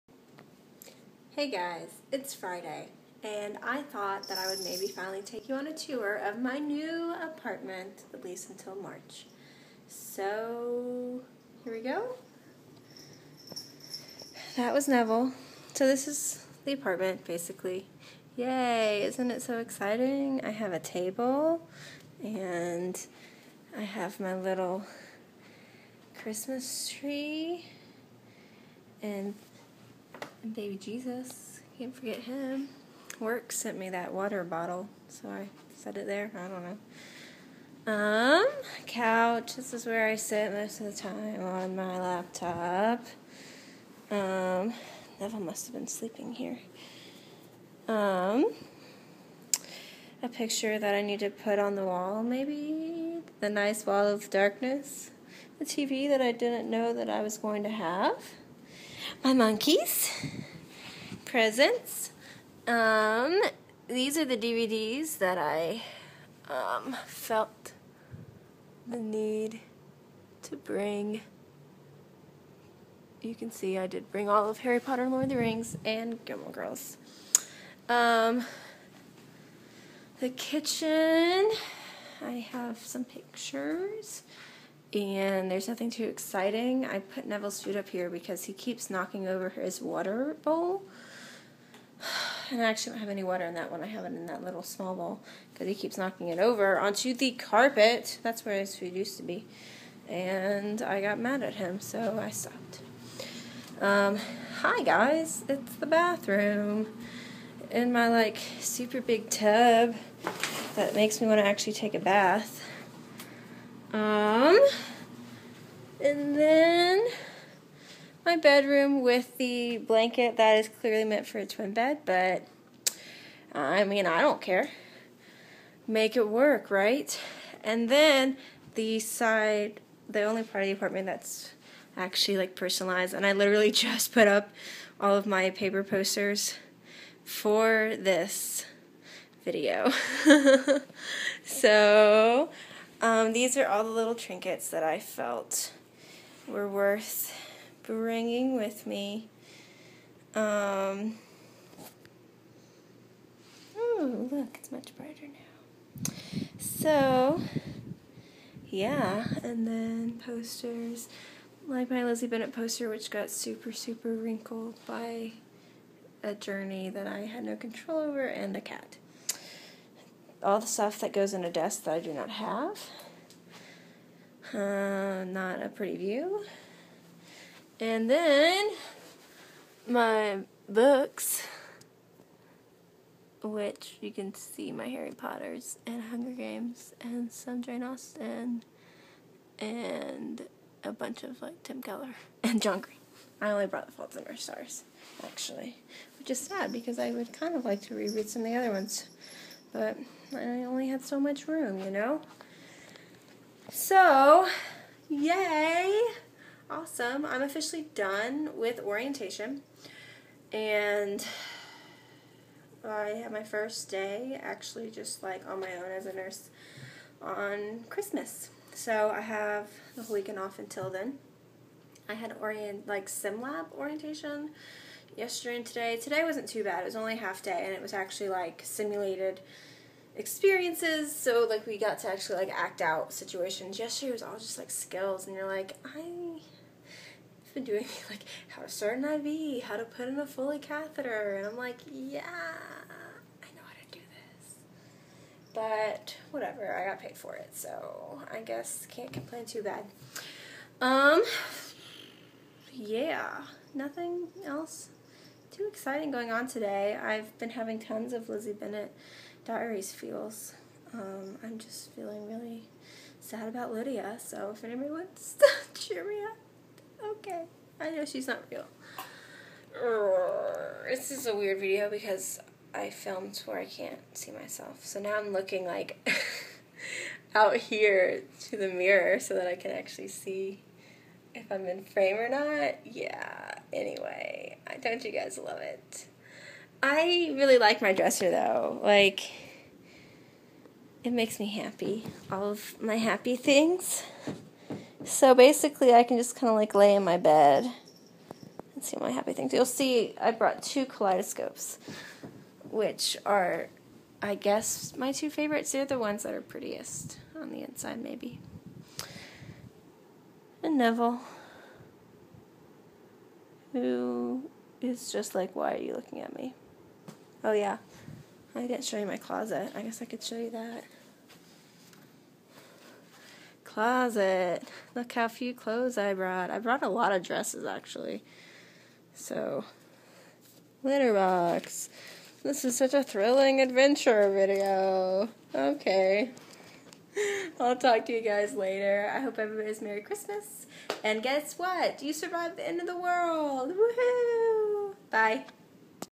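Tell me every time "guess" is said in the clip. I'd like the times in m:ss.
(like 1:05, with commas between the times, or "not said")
4:08, 5:04, 5:19, 5:41.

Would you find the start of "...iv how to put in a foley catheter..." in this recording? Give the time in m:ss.
3:59.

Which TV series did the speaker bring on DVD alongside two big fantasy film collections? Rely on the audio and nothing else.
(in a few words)
Gilmore Girls.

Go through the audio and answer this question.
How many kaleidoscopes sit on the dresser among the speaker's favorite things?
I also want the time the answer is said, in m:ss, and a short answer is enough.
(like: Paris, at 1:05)
2, at 5:00.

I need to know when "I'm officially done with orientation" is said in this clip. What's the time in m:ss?
3:27.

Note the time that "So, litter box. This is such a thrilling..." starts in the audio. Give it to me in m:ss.
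5:29.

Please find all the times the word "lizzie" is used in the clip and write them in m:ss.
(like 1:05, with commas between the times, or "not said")
2:42, 4:18.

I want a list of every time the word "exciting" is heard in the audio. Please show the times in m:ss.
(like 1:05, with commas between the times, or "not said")
0:19, 1:26, 4:15.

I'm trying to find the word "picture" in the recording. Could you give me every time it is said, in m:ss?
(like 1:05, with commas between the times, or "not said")
0:50, 1:23.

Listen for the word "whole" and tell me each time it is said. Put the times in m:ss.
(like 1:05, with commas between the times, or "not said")
3:40.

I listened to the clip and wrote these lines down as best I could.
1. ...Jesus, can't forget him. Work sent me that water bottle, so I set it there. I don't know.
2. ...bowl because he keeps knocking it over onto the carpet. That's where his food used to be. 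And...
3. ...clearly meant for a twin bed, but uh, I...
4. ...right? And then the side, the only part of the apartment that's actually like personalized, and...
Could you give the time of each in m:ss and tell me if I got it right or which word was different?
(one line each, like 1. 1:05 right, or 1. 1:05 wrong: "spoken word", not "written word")
1. 0:30 right
2. 1:34 right
3. 2:00 right
4. 2:06 right.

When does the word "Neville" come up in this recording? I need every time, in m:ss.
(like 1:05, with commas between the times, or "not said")
0:14, 0:45, 1:27, 5:10.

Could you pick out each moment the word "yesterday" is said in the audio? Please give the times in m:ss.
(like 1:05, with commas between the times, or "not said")
3:45, 3:53.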